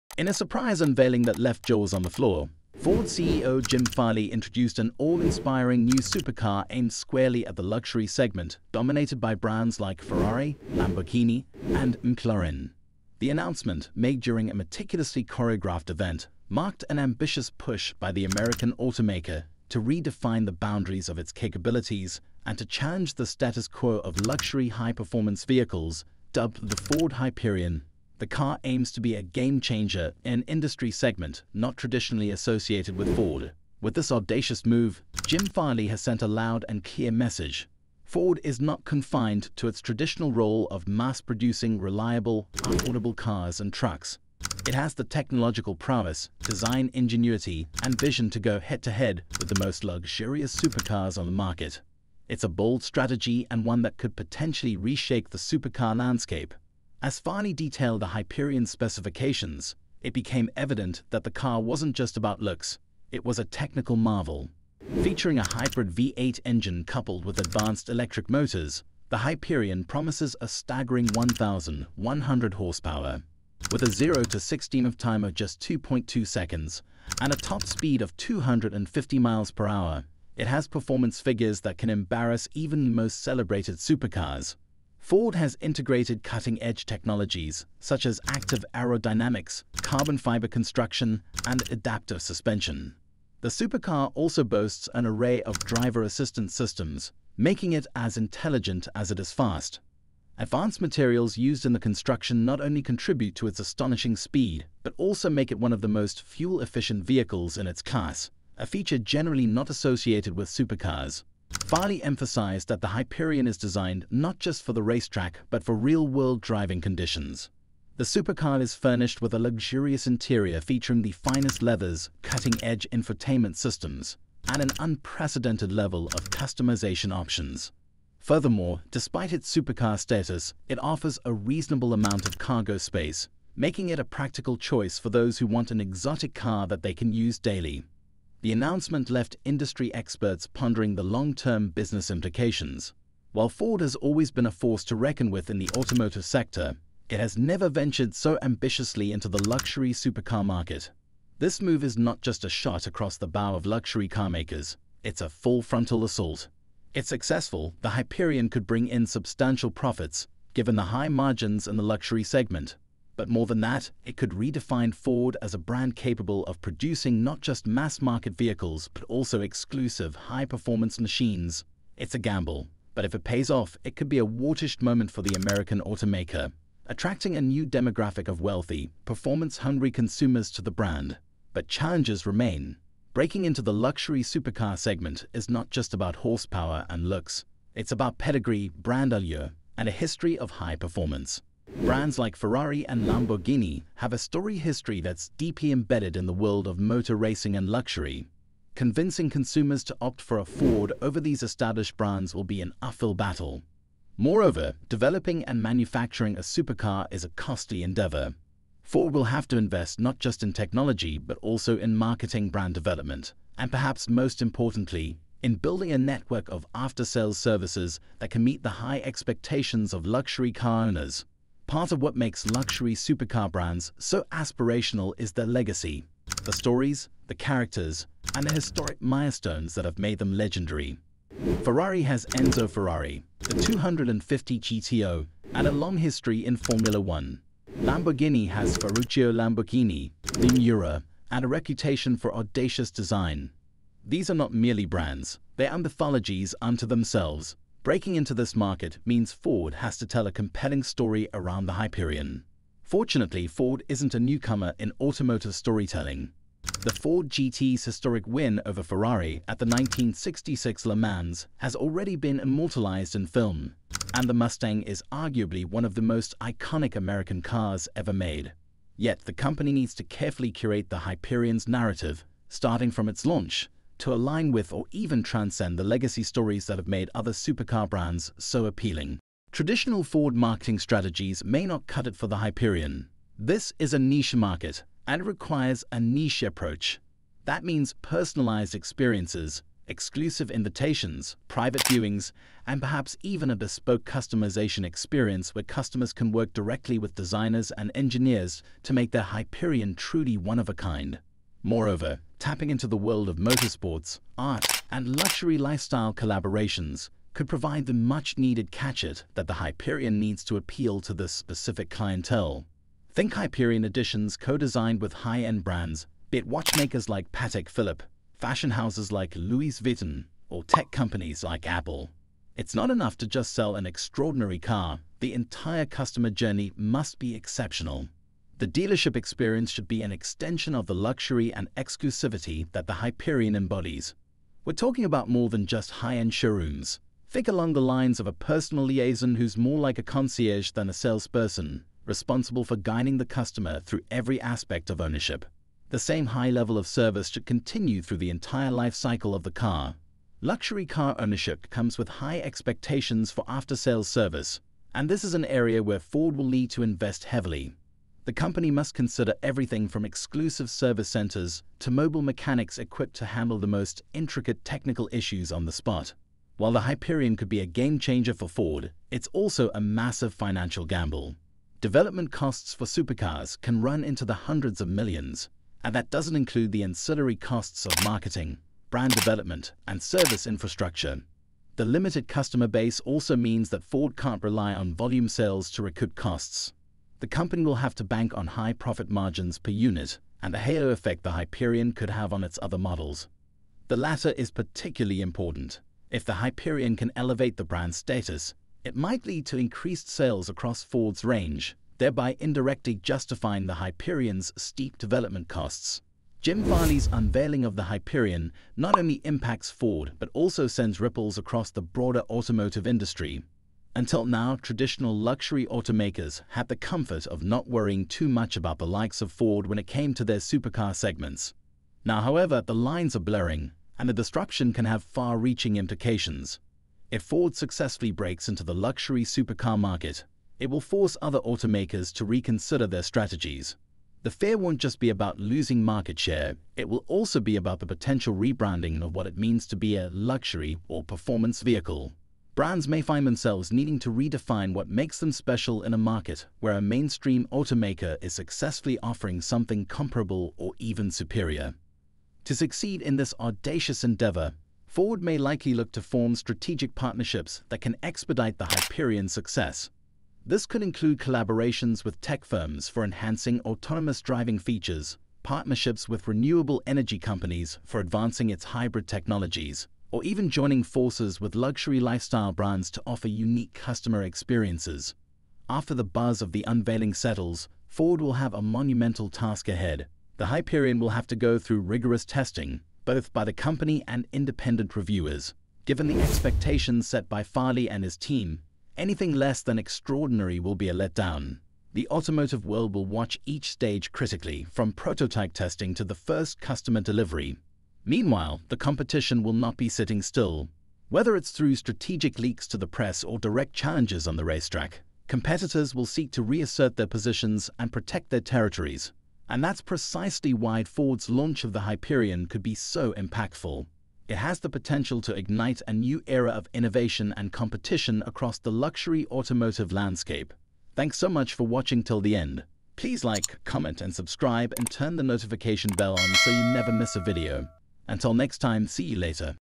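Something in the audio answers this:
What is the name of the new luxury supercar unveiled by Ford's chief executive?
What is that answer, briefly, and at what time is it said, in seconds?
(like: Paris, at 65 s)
Ford Hyperion, at 26 s.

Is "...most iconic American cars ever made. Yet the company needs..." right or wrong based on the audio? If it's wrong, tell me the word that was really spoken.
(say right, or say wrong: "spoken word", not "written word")
right.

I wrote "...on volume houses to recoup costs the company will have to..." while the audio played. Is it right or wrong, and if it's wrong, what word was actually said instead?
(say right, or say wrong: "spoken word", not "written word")
wrong: "sales", not "houses".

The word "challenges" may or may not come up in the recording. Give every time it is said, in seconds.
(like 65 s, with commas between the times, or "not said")
22 s, 181 s, 503 s.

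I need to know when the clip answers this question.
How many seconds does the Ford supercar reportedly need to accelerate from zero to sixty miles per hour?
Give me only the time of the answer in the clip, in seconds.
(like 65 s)
75 s.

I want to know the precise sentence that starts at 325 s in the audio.
The entire customer journey must be exceptional.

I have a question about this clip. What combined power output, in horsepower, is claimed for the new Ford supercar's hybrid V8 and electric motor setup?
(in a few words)
1,100.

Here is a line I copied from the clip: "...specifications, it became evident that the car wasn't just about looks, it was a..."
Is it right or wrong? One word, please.
right.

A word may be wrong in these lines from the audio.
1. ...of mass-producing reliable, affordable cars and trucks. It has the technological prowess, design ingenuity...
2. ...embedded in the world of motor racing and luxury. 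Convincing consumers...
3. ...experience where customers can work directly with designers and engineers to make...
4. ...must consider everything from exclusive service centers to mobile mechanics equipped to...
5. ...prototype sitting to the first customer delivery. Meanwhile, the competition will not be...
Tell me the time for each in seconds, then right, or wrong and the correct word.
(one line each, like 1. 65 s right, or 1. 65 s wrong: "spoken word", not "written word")
1. 40 s right
2. 195 s right
3. 294 s right
4. 358 s right
5. 494 s wrong: "testing", not "sitting".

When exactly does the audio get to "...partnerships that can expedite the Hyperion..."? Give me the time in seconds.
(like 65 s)
456 s.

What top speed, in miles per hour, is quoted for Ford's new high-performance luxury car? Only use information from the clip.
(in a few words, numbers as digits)
250.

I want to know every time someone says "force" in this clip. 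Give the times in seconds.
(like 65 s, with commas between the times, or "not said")
144 s, 430 s, 470 s.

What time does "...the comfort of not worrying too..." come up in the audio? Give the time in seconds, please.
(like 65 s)
416 s.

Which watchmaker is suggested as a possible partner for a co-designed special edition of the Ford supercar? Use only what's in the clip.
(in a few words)
Patek Philippe.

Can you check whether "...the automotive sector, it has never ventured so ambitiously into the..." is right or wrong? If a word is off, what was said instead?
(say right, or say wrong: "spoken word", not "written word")
right.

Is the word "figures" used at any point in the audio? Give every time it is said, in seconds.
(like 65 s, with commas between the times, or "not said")
81 s.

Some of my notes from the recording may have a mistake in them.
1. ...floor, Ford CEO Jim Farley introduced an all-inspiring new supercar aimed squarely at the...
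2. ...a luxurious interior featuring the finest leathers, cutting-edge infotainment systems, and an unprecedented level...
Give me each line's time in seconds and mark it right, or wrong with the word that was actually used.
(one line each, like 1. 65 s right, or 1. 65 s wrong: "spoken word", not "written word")
1. 2 s right
2. 119 s right.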